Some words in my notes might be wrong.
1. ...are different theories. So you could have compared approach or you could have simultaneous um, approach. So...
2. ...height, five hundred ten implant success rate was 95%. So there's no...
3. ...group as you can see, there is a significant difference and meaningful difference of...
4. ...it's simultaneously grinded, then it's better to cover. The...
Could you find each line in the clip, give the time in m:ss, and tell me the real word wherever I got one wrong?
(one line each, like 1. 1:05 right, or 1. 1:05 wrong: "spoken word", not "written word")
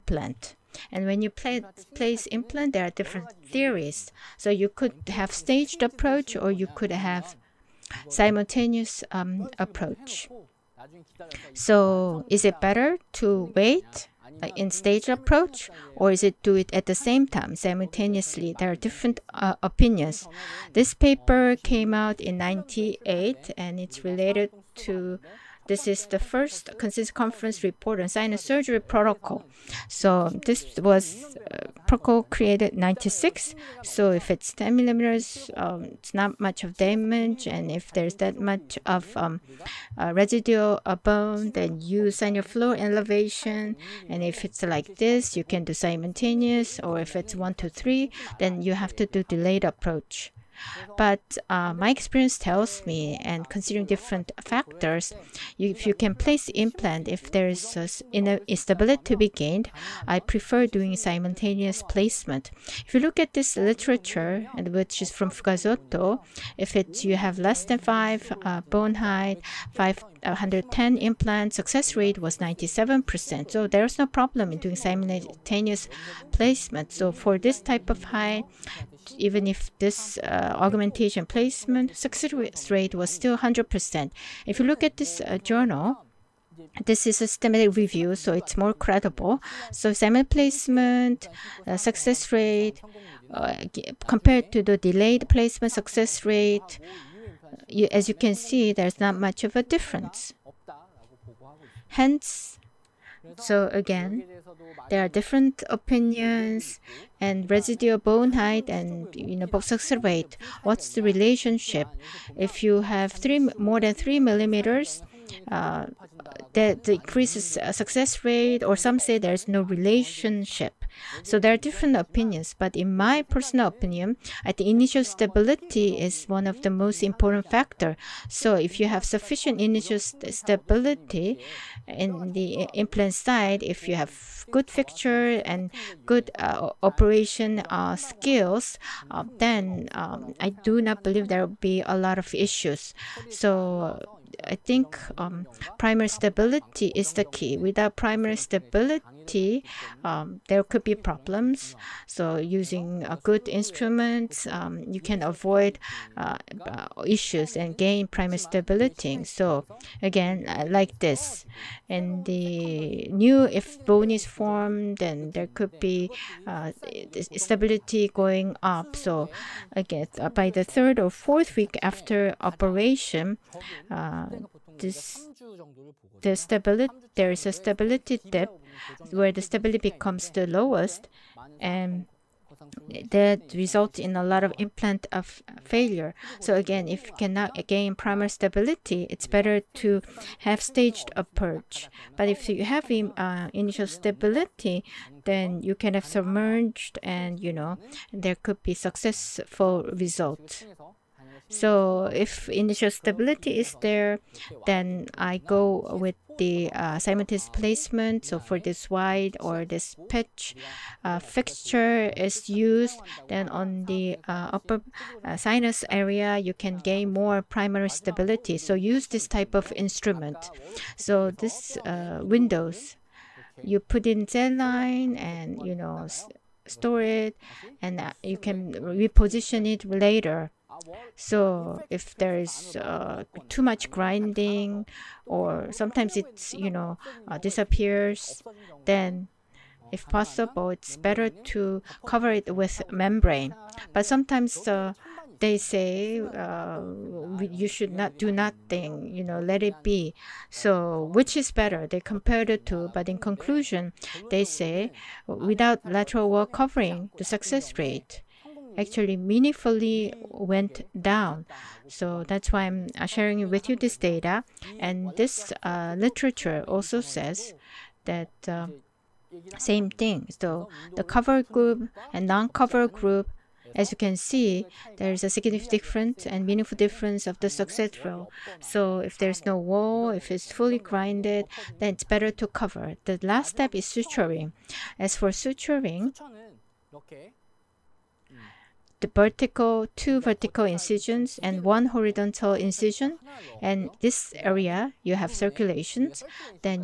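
1. 0:02 wrong: "staged", not "compared"
2. 1:08 wrong: "97", not "95"
3. 4:32 right
4. 4:40 wrong: "fully", not "simultaneously".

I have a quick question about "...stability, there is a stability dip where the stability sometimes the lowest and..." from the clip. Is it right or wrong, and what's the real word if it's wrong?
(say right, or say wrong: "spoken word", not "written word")
wrong: "becomes", not "sometimes".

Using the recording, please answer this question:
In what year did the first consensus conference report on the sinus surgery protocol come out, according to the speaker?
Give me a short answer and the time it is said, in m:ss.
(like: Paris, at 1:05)
1998, at 0:22.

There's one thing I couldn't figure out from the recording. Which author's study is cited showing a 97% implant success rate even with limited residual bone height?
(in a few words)
Fugazzotto.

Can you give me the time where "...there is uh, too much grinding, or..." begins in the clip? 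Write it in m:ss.
3:52.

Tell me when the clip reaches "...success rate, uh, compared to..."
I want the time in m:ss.
1:31.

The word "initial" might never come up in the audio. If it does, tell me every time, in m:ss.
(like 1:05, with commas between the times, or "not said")
2:04, 2:09, 3:13, 3:22.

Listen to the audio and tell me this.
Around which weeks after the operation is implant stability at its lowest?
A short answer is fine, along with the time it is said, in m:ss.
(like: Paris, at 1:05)
third or fourth week, at 2:50.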